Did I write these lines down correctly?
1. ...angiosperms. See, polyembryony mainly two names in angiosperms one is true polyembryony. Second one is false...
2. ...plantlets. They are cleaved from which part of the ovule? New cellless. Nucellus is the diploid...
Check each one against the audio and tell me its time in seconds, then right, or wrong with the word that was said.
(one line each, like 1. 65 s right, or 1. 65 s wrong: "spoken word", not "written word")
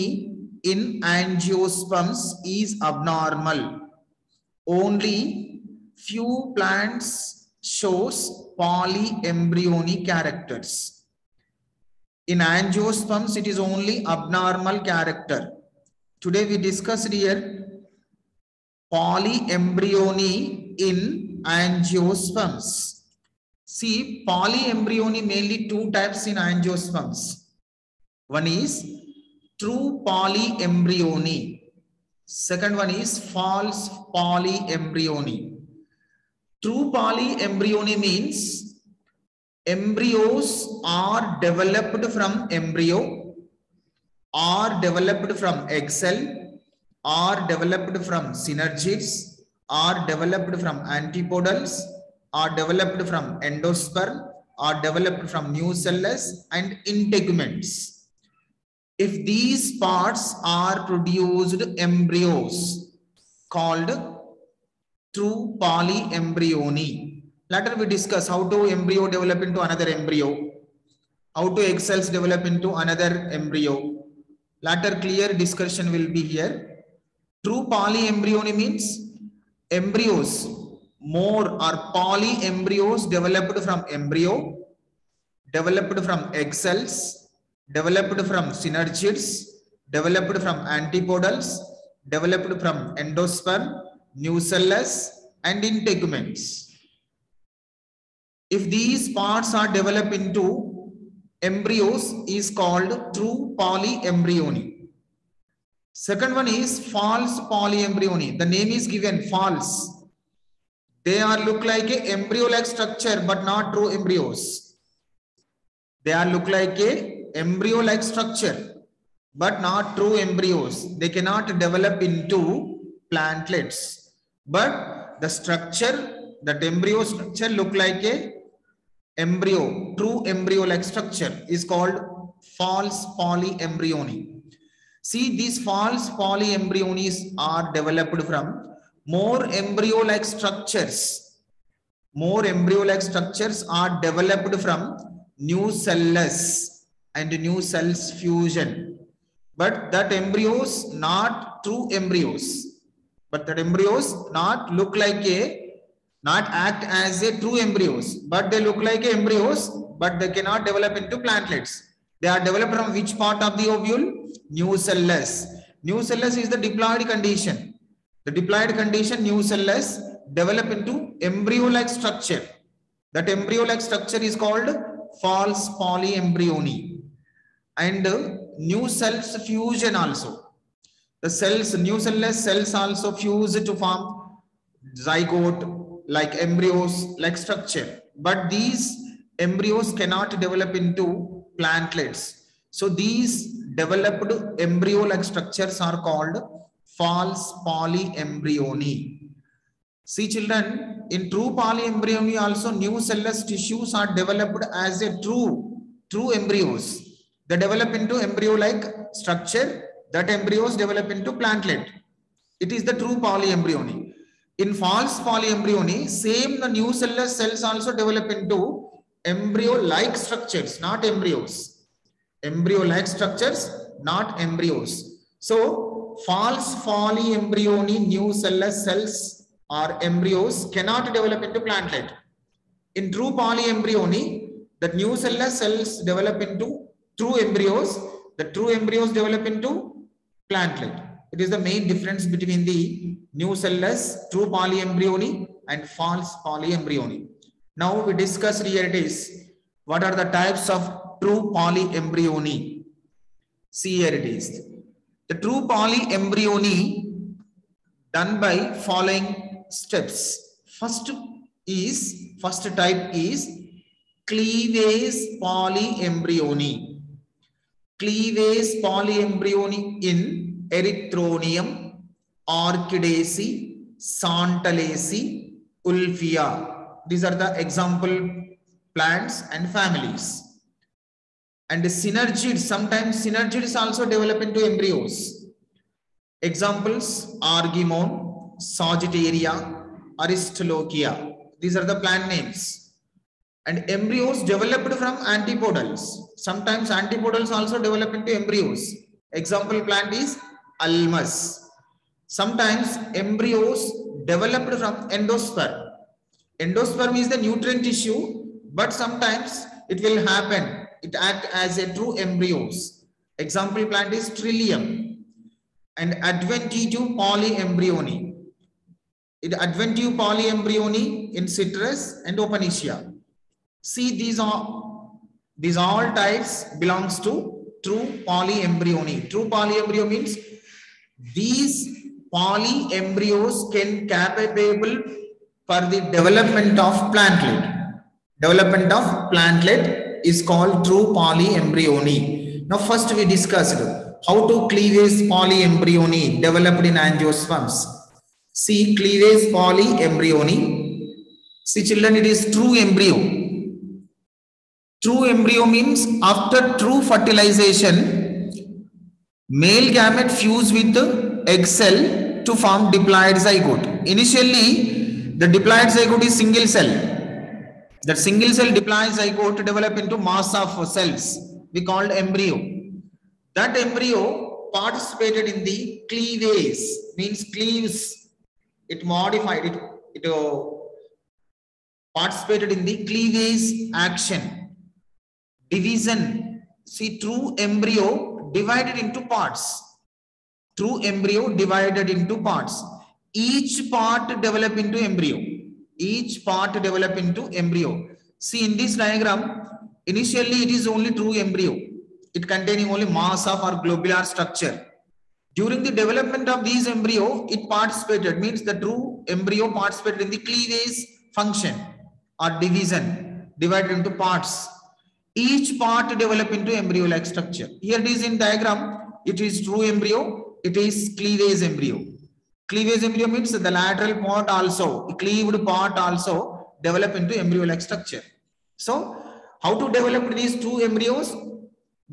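1. 21 s wrong: "types", not "names"
2. 161 s wrong: "developed", not "cleaved".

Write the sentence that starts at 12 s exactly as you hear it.
In angiosperms, it is only abnormal character.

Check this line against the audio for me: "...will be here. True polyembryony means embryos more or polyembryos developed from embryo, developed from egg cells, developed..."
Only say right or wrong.
right.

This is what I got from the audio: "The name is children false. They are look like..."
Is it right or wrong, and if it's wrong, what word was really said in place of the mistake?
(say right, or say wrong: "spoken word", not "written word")
wrong: "given", not "children".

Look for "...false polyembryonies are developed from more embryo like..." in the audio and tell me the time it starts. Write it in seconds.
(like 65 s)
135 s.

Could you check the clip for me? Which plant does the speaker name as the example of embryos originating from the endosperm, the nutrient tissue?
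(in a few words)
Trillium.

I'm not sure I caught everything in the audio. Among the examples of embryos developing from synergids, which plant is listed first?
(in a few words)
Argemone.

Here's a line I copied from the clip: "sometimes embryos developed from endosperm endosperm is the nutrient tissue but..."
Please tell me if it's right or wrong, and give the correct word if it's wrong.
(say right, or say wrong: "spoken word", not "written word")
right.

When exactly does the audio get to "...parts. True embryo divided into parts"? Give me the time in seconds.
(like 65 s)
389 s.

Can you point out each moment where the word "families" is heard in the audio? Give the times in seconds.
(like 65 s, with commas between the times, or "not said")
279 s.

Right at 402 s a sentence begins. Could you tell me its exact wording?
It containing only mass of our globular structure.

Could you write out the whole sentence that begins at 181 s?
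The cells, nucellus cells also fuse to form zygote, like embryos, like structure.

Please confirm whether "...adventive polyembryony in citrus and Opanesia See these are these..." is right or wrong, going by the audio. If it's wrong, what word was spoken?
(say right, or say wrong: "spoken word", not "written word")
right.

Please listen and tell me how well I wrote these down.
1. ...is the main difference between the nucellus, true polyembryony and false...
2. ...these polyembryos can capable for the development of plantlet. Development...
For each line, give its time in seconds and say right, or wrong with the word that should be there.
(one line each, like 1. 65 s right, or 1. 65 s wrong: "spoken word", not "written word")
1. 241 s right
2. 331 s right.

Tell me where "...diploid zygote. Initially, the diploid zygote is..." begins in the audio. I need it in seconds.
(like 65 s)
362 s.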